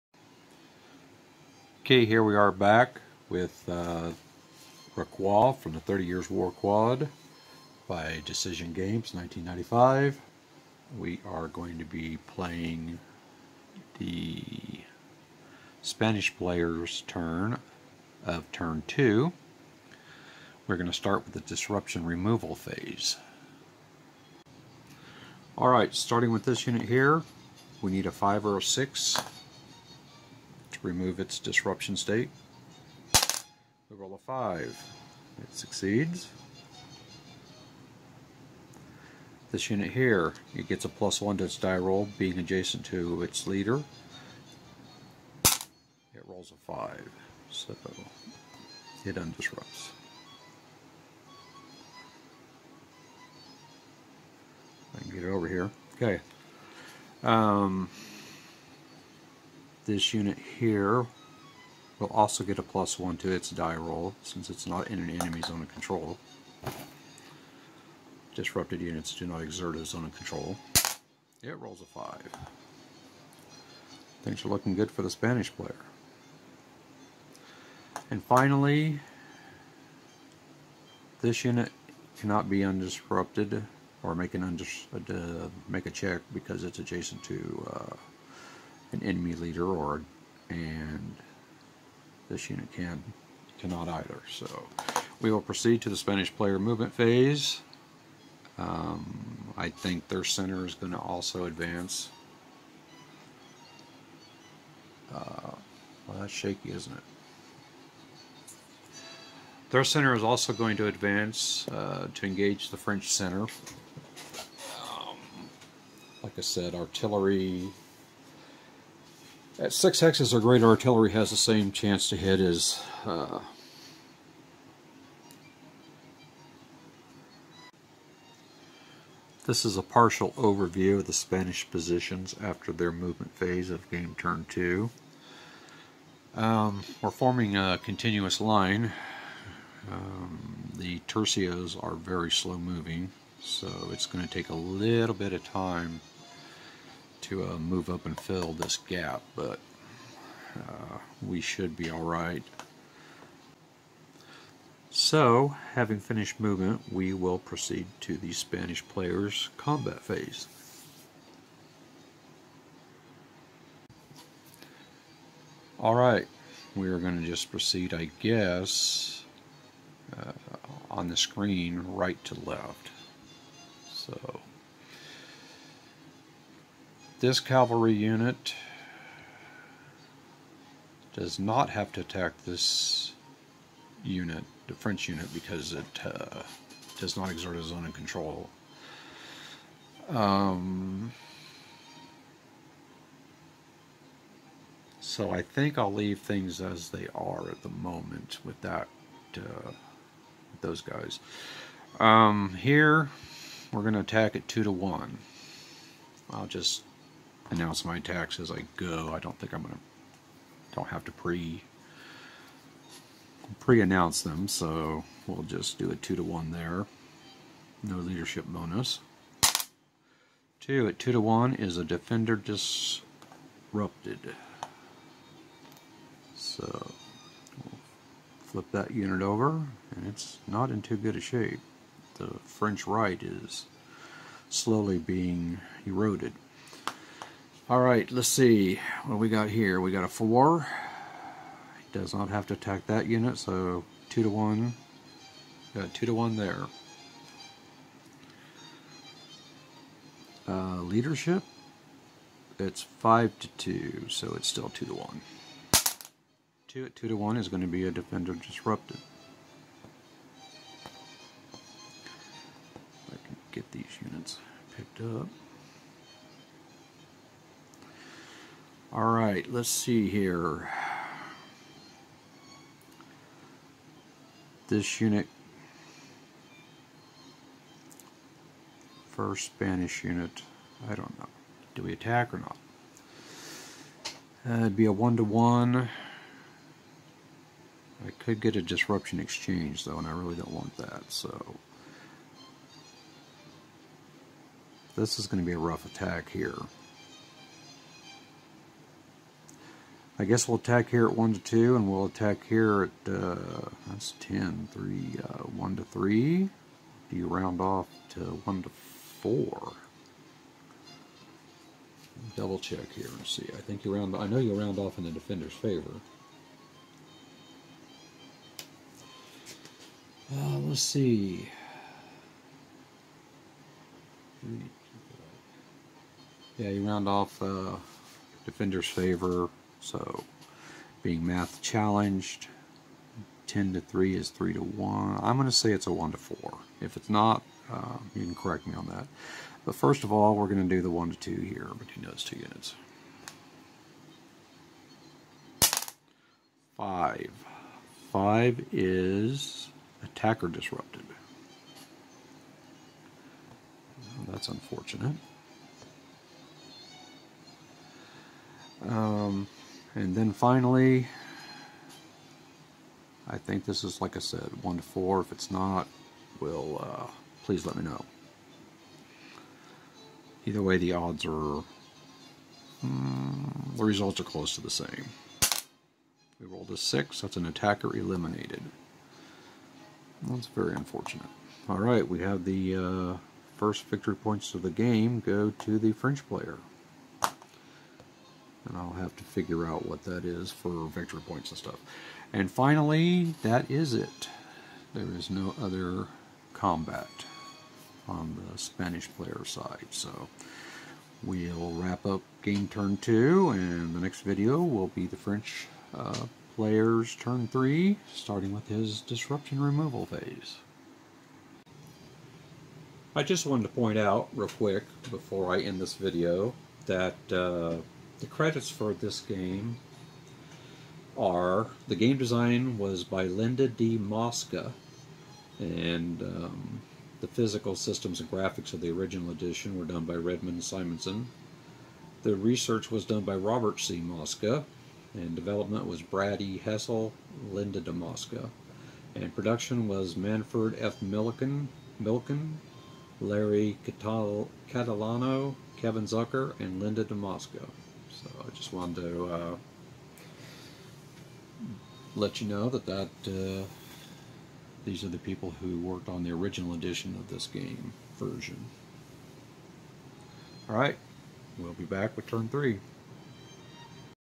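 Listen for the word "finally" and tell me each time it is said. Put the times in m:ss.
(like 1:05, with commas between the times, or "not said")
1:18, 6:00, 6:32.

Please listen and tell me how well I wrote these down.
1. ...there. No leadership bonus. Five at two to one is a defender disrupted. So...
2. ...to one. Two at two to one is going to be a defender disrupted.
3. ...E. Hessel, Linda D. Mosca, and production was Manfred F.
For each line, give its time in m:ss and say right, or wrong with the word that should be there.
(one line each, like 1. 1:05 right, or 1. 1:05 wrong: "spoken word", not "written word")
1. 3:36 wrong: "Two", not "Five"
2. 4:14 right
3. 7:16 right.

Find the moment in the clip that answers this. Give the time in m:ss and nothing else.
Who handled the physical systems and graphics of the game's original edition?
7:10.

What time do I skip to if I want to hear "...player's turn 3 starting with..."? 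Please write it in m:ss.
6:46.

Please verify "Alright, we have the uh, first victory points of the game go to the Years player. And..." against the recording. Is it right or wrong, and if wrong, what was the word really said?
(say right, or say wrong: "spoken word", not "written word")
wrong: "French", not "Years".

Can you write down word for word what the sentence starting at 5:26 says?
Yeah, you round off uh, defender's favor.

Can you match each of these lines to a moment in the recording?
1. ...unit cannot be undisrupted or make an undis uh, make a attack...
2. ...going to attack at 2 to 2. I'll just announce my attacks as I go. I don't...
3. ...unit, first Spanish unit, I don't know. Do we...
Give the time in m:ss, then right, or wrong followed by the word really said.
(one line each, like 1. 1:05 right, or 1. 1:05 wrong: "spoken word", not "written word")
1. 1:21 wrong: "check", not "attack"
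2. 3:23 wrong: "1", not "2"
3. 4:34 right.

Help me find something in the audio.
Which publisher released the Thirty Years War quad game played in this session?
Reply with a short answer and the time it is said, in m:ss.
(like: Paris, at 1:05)
Decision Games, at 0:08.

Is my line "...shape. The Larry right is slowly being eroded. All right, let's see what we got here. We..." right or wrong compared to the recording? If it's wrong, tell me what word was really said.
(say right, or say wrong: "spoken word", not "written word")
wrong: "French", not "Larry".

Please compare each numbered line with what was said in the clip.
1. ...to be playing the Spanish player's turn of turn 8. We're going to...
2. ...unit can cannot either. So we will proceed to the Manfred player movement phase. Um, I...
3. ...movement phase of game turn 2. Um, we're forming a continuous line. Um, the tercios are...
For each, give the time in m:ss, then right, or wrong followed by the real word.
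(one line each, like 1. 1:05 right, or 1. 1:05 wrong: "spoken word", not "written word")
1. 0:11 wrong: "2", not "8"
2. 1:32 wrong: "Spanish", not "Manfred"
3. 2:12 right.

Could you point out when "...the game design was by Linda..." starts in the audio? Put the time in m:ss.
7:01.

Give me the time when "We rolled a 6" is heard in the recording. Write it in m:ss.
6:16.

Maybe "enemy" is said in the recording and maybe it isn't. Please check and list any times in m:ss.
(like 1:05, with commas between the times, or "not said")
1:05, 1:29.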